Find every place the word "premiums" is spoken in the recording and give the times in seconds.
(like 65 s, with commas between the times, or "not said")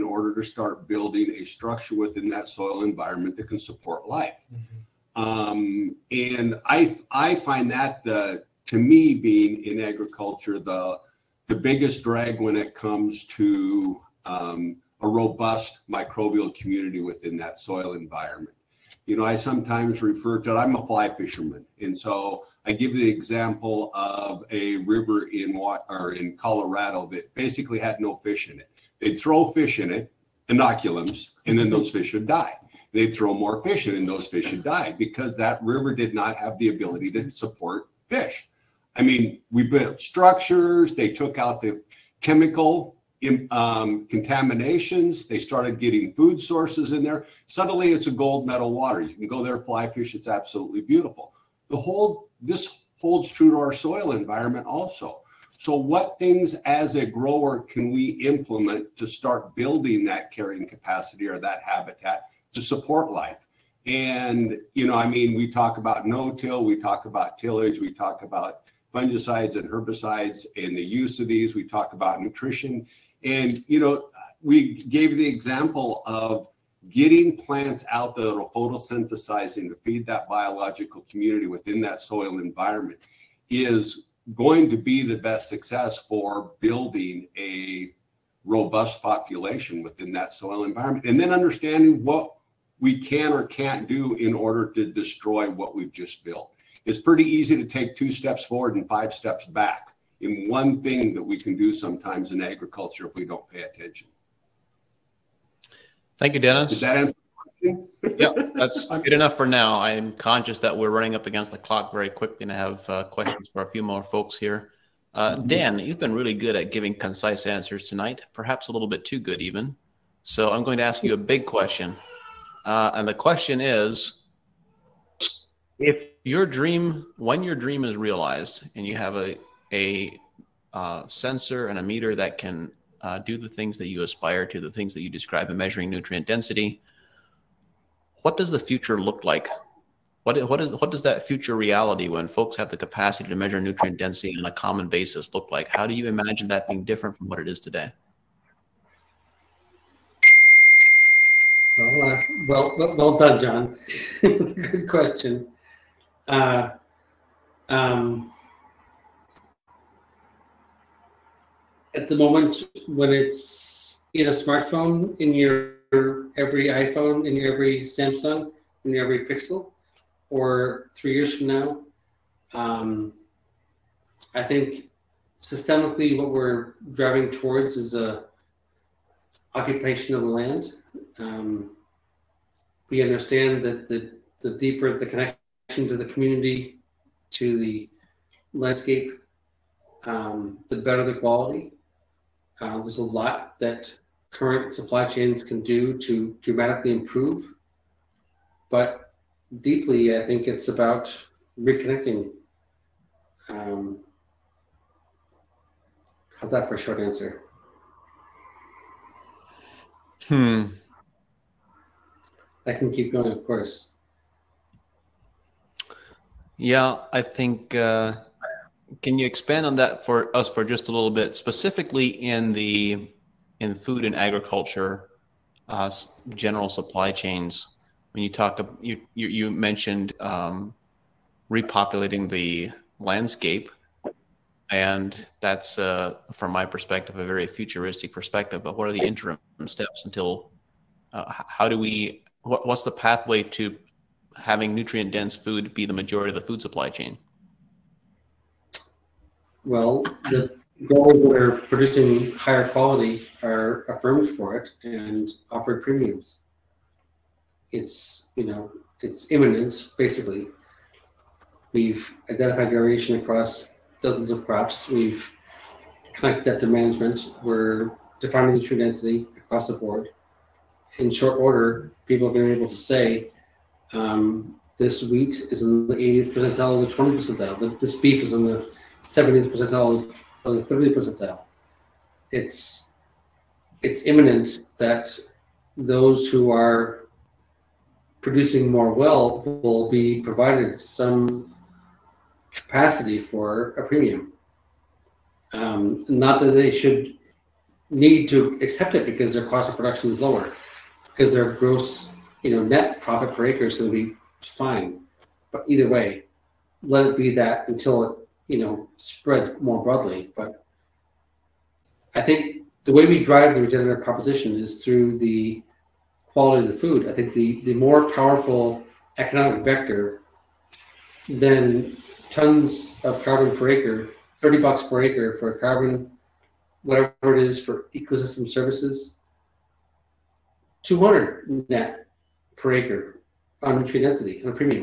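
255 s, 293 s.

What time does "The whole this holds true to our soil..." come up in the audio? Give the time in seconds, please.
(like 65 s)
51 s.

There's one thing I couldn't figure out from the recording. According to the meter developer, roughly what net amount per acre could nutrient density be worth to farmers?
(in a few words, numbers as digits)
200.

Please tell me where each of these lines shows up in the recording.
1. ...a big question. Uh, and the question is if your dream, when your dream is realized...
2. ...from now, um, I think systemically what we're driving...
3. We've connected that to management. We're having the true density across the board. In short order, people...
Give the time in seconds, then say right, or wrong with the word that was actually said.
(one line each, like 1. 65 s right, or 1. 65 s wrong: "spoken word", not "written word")
1. 121 s right
2. 171 s right
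3. 264 s wrong: "defining", not "having".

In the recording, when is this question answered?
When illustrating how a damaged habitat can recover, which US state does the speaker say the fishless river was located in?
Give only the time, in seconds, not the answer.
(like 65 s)
26 s.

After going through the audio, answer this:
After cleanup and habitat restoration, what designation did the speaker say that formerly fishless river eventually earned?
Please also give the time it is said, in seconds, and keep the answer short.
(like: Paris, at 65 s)
gold medal water, at 48 s.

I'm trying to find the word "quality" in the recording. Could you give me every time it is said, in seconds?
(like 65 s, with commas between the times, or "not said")
191 s, 252 s, 316 s.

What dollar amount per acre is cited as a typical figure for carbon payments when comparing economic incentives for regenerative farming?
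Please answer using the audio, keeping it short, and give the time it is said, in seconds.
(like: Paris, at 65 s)
$30, at 324 s.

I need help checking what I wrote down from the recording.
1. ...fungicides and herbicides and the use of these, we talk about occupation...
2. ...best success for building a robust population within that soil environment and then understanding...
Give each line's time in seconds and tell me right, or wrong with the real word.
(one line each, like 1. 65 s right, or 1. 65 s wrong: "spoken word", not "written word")
1. 68 s wrong: "nutrition", not "occupation"
2. 85 s right.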